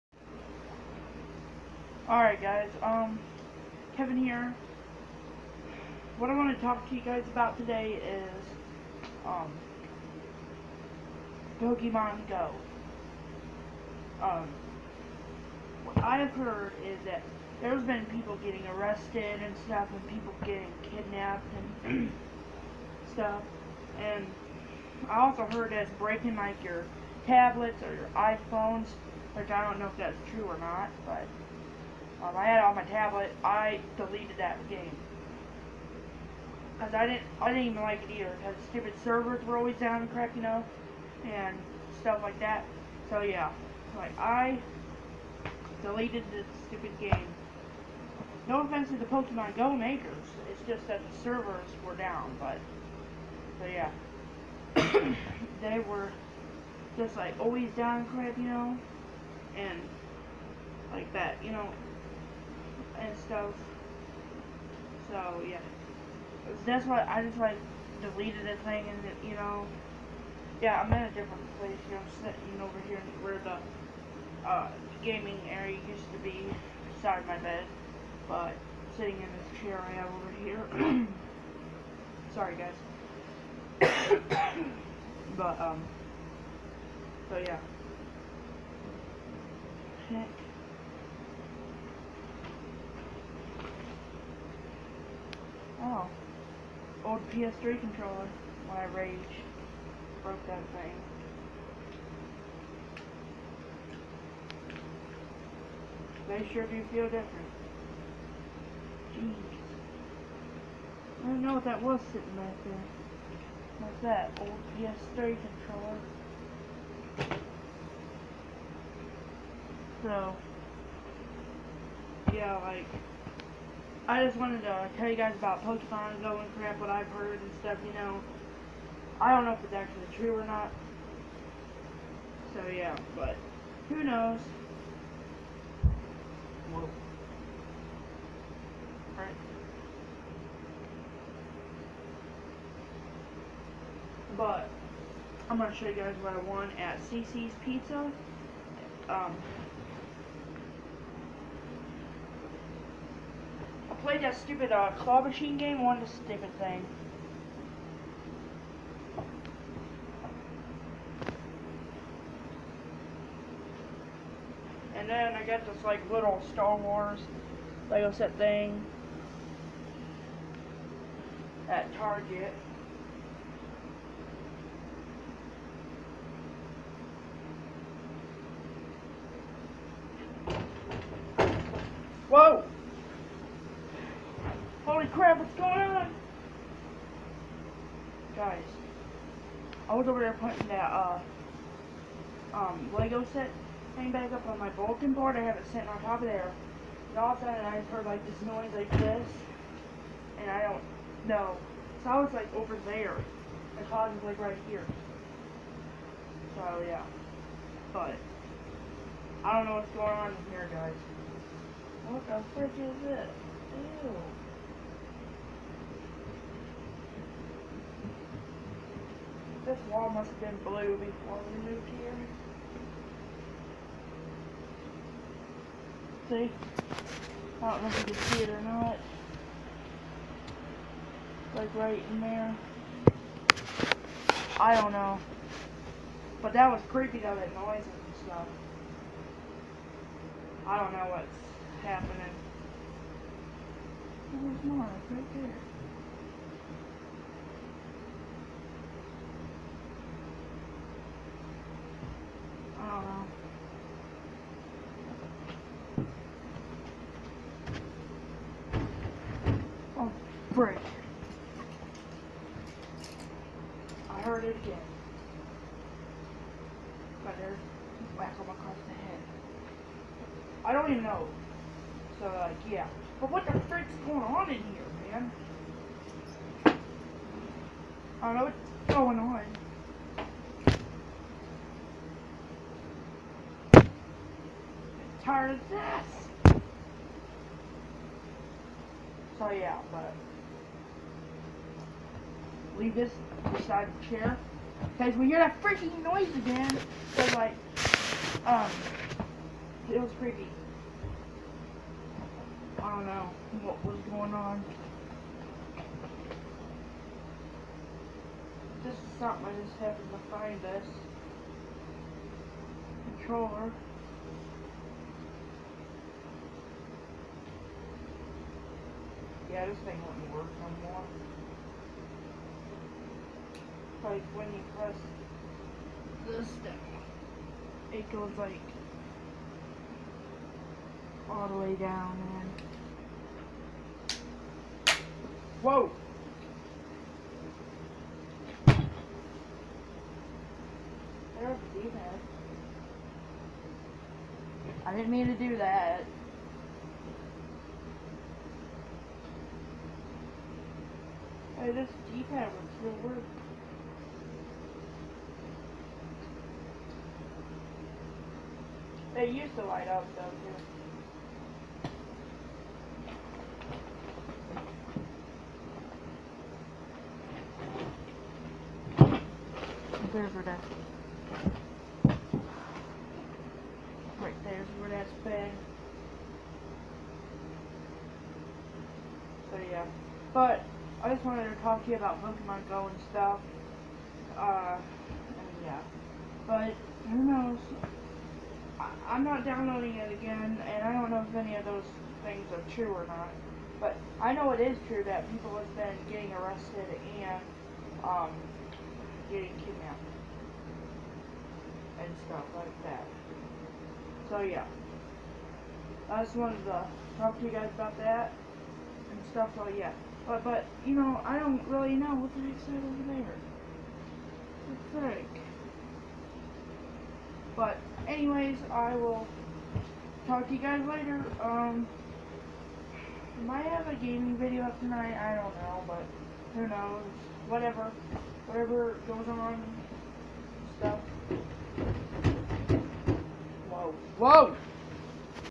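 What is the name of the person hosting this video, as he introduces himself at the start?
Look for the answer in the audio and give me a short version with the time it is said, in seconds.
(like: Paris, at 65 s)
Kevin, at 3 s.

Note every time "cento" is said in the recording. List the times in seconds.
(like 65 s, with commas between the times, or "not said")
not said.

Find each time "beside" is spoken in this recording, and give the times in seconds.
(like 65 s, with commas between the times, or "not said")
76 s, 293 s.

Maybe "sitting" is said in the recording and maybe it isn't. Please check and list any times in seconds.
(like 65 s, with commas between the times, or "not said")
72 s, 78 s, 112 s, 195 s.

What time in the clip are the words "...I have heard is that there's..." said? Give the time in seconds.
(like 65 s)
15 s.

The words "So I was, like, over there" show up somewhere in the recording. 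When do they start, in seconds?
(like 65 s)
202 s.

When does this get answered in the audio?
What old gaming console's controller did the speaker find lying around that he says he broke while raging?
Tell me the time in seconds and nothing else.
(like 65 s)
97 s.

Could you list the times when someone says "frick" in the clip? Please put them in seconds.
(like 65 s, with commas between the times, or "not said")
212 s, 273 s.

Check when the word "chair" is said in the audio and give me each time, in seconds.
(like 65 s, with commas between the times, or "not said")
79 s, 294 s.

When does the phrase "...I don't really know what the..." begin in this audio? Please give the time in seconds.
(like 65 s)
411 s.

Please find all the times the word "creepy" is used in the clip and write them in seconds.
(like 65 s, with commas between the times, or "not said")
236 s, 300 s.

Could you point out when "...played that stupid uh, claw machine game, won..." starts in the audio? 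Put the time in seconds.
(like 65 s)
154 s.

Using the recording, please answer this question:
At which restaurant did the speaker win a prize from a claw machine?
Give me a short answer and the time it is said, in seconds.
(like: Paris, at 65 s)
CiCi's Pizza, at 147 s.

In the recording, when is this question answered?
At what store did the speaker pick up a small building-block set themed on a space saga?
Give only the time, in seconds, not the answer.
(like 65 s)
171 s.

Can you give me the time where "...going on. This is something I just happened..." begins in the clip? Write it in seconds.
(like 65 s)
304 s.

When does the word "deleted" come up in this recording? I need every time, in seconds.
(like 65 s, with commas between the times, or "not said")
33 s, 45 s, 68 s.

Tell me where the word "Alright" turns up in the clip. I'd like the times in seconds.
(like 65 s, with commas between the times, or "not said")
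2 s.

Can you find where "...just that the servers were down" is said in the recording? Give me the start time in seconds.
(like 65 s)
50 s.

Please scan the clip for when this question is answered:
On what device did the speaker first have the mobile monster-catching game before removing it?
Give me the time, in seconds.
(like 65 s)
32 s.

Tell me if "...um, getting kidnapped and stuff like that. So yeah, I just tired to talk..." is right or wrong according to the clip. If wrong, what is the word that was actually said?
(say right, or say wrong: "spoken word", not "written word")
wrong: "wanted", not "tired".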